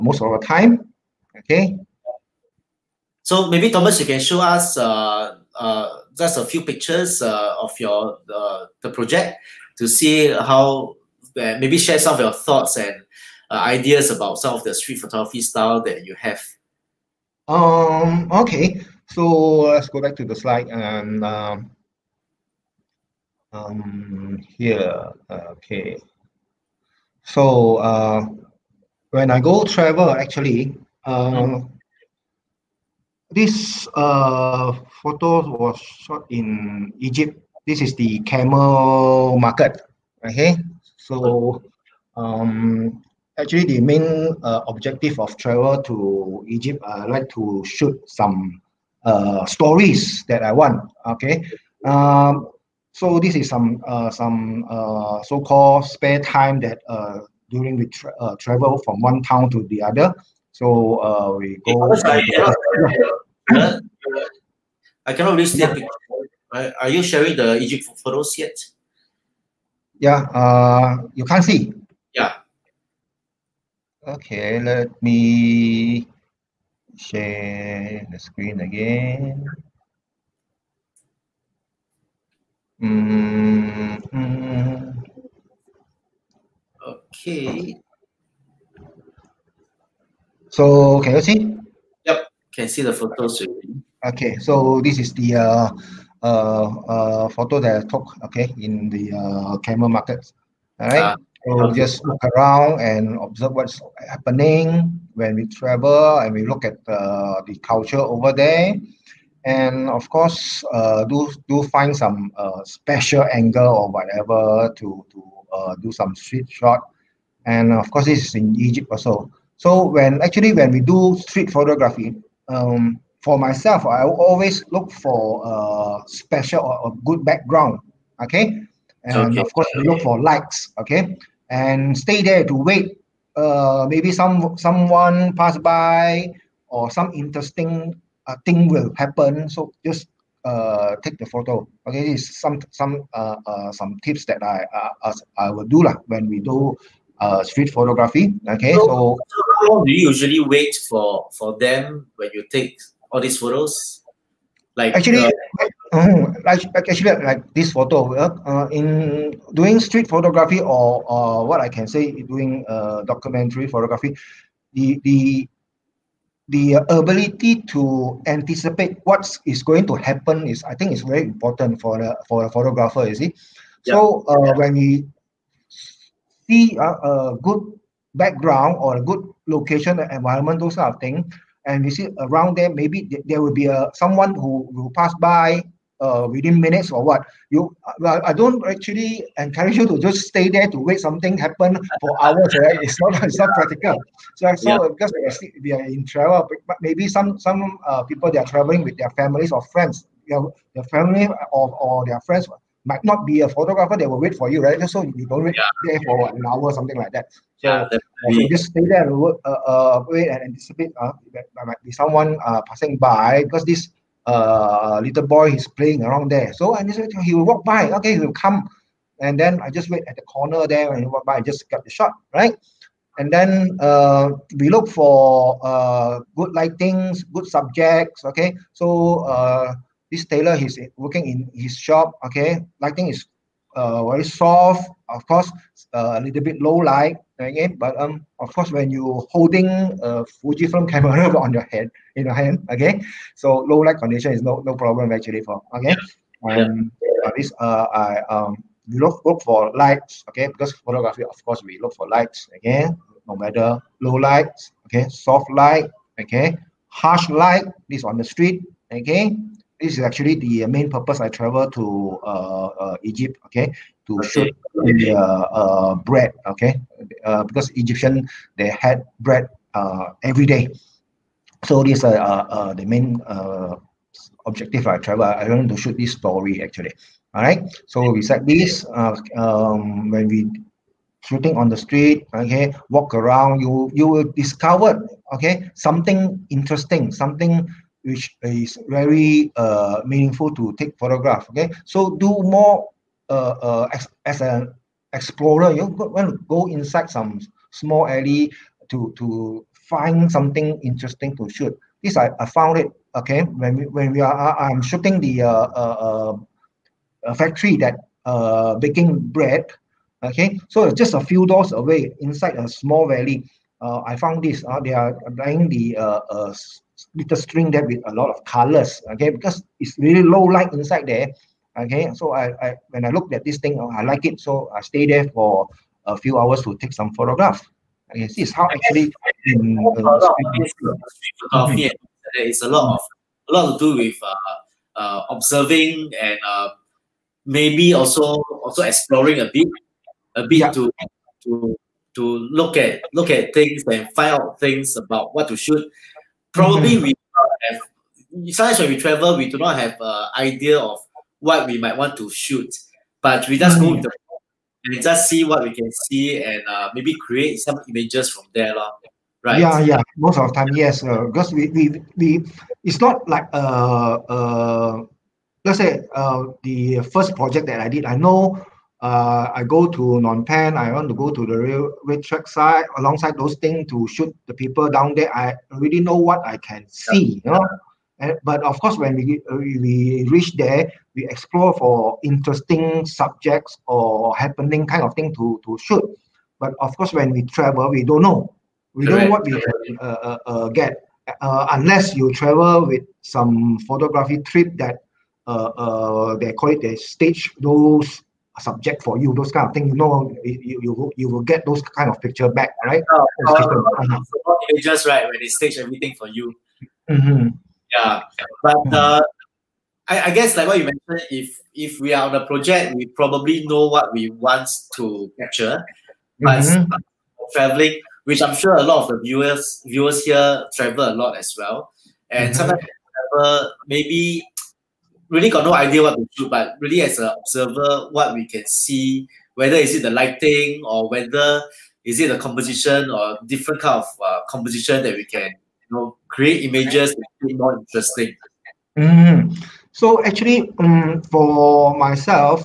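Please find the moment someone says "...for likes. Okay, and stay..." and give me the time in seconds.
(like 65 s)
130 s.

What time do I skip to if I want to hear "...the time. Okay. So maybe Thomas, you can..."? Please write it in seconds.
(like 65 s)
0 s.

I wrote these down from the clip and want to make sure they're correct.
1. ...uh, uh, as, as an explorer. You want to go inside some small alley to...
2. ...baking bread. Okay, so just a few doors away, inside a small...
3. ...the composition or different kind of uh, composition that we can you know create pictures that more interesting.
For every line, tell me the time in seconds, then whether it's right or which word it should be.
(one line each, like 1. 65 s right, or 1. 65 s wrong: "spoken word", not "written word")
1. 293 s right
2. 308 s right
3. 432 s wrong: "images", not "pictures".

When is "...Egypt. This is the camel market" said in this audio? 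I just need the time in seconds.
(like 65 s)
36 s.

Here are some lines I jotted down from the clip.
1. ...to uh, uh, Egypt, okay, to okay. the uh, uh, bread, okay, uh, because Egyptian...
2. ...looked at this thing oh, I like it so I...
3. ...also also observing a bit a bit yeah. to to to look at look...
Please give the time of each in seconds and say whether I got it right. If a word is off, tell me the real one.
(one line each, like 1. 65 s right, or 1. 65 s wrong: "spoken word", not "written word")
1. 261 s right
2. 323 s right
3. 337 s wrong: "exploring", not "observing".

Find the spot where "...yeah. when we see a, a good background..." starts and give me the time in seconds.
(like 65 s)
174 s.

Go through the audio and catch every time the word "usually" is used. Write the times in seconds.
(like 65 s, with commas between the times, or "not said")
150 s.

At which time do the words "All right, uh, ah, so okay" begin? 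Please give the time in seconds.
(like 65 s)
100 s.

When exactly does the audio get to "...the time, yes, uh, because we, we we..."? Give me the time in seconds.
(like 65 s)
360 s.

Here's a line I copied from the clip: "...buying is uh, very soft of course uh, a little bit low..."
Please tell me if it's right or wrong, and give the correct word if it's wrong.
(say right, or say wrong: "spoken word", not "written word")
wrong: "lighting", not "buying".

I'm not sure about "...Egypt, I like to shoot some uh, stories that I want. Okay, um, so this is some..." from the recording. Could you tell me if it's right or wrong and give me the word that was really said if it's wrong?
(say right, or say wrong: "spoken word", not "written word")
right.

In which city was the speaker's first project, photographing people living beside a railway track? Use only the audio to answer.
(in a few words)
Phnom Penh.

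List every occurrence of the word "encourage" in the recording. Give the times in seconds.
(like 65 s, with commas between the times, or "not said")
189 s.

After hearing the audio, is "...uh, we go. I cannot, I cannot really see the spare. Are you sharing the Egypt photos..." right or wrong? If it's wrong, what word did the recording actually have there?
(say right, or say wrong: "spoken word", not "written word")
wrong: "picture", not "spare".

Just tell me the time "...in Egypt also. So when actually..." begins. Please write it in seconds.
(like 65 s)
118 s.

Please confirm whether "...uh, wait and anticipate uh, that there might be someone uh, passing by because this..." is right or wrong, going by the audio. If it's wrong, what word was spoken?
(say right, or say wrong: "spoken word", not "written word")
right.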